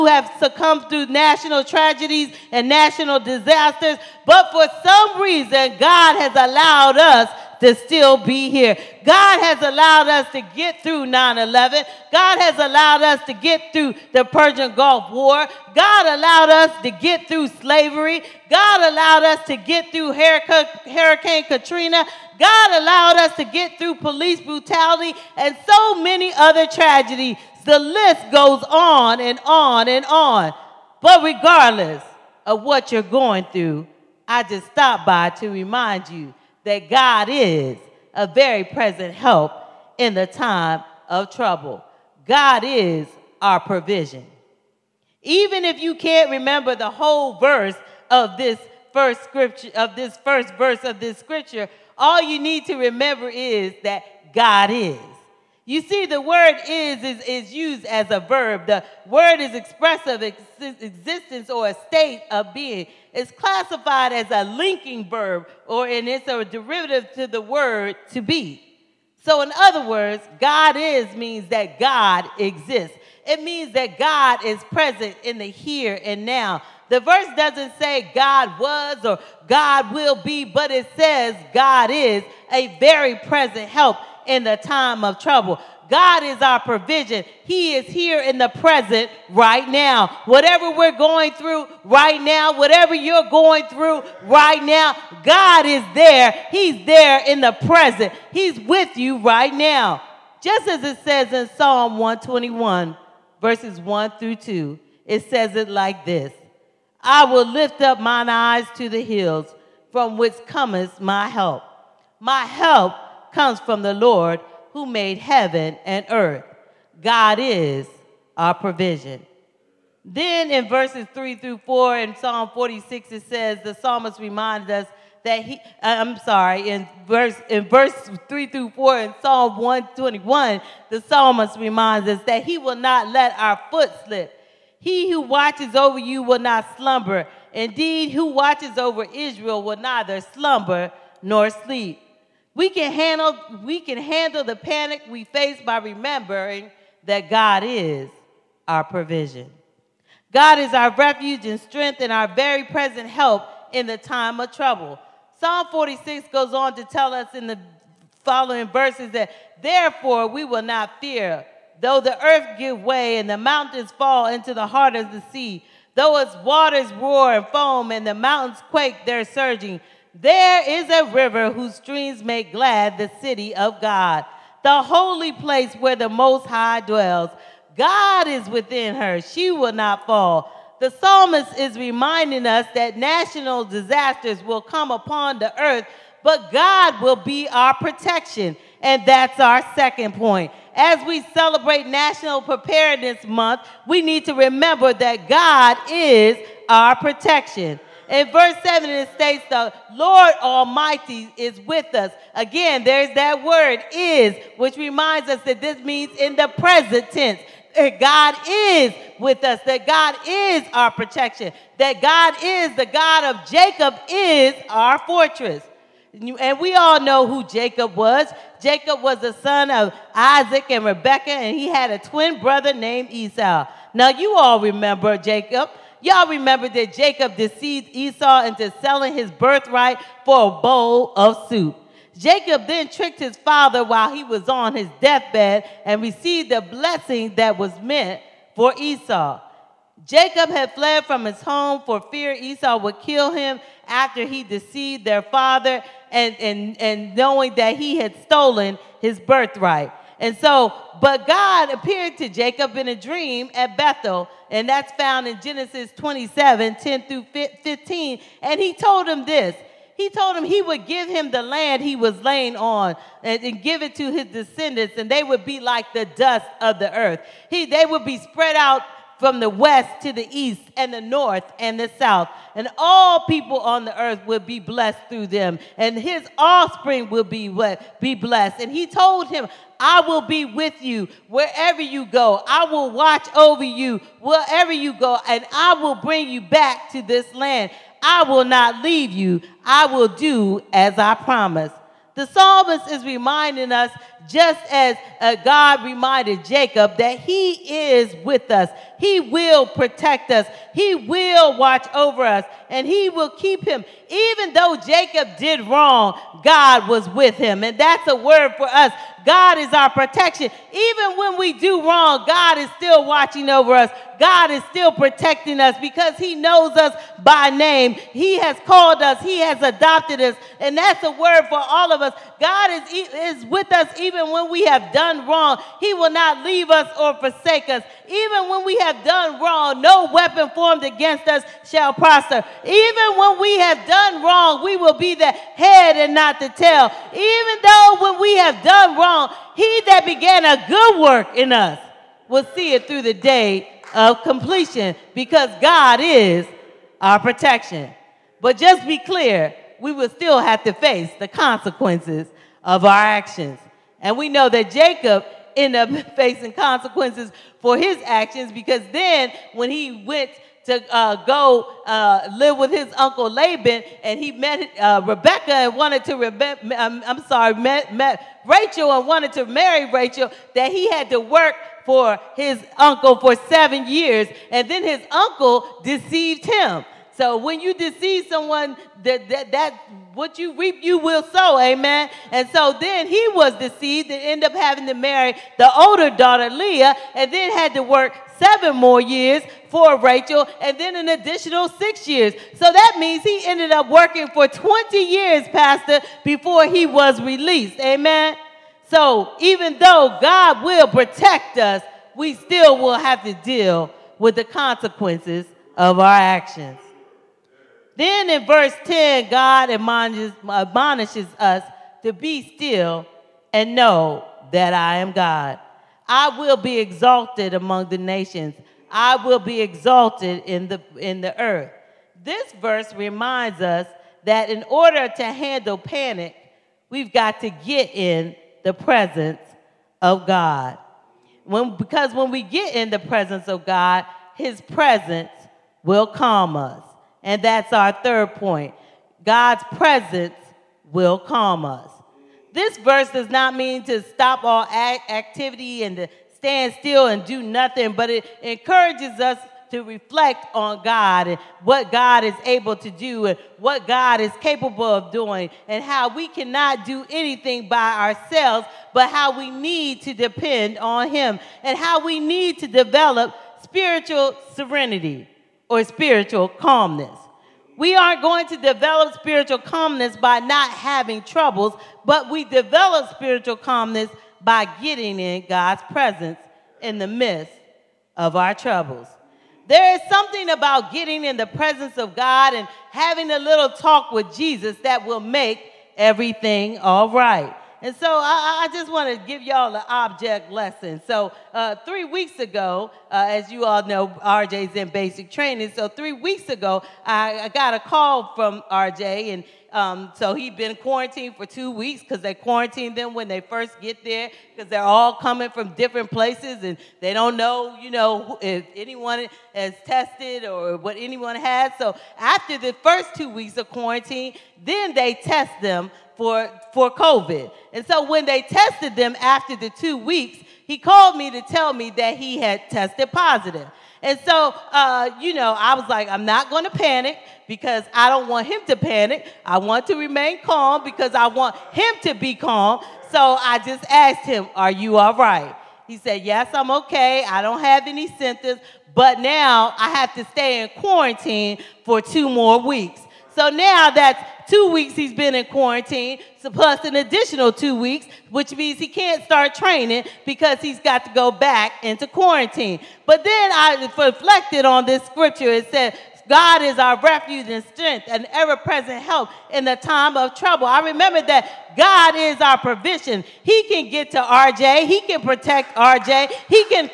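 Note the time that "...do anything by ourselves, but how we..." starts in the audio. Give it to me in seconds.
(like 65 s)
456 s.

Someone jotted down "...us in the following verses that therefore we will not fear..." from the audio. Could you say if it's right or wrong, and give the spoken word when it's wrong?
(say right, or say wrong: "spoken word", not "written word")
right.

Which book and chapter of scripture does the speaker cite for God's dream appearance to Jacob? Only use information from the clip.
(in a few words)
Genesis 27.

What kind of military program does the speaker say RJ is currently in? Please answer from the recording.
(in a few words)
basic training.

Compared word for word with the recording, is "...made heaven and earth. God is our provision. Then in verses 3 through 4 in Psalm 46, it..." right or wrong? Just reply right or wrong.
right.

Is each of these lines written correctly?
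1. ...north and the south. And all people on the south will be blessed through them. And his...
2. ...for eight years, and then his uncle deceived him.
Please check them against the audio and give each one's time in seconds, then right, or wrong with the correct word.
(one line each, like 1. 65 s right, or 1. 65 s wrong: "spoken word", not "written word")
1. 271 s wrong: "earth", not "south"
2. 373 s wrong: "seven", not "eight".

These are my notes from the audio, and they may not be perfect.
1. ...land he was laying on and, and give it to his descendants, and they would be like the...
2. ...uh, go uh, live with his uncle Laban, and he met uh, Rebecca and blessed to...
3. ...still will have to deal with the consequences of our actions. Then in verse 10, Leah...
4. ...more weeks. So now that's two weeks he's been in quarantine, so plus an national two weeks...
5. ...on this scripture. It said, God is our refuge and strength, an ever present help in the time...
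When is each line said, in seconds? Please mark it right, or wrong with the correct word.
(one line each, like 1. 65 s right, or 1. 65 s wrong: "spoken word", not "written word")
1. 261 s right
2. 360 s wrong: "wanted", not "blessed"
3. 402 s wrong: "God", not "Leah"
4. 542 s wrong: "additional", not "national"
5. 554 s right.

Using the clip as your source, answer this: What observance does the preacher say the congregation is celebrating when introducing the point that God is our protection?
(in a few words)
National Preparedness Month.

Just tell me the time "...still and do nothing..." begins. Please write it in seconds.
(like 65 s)
446 s.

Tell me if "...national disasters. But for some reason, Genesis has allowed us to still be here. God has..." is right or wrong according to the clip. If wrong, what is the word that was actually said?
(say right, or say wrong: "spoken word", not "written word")
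wrong: "God", not "Genesis".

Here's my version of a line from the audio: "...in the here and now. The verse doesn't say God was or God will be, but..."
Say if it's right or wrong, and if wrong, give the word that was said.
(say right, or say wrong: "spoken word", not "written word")
right.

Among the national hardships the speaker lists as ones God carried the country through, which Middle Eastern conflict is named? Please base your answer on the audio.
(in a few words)
Persian Gulf War.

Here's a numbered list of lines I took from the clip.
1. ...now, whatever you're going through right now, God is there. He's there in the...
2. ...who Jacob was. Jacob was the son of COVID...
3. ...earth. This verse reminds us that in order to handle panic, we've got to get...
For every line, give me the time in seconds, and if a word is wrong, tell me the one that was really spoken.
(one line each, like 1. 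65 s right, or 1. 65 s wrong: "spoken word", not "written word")
1. 92 s right
2. 217 s wrong: "Isaac", not "COVID"
3. 421 s right.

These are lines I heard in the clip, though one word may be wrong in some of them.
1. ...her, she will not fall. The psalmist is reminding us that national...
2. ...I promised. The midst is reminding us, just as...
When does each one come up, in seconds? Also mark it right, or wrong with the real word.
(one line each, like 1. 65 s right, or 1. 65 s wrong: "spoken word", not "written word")
1. 178 s right
2. 290 s wrong: "psalmist", not "midst".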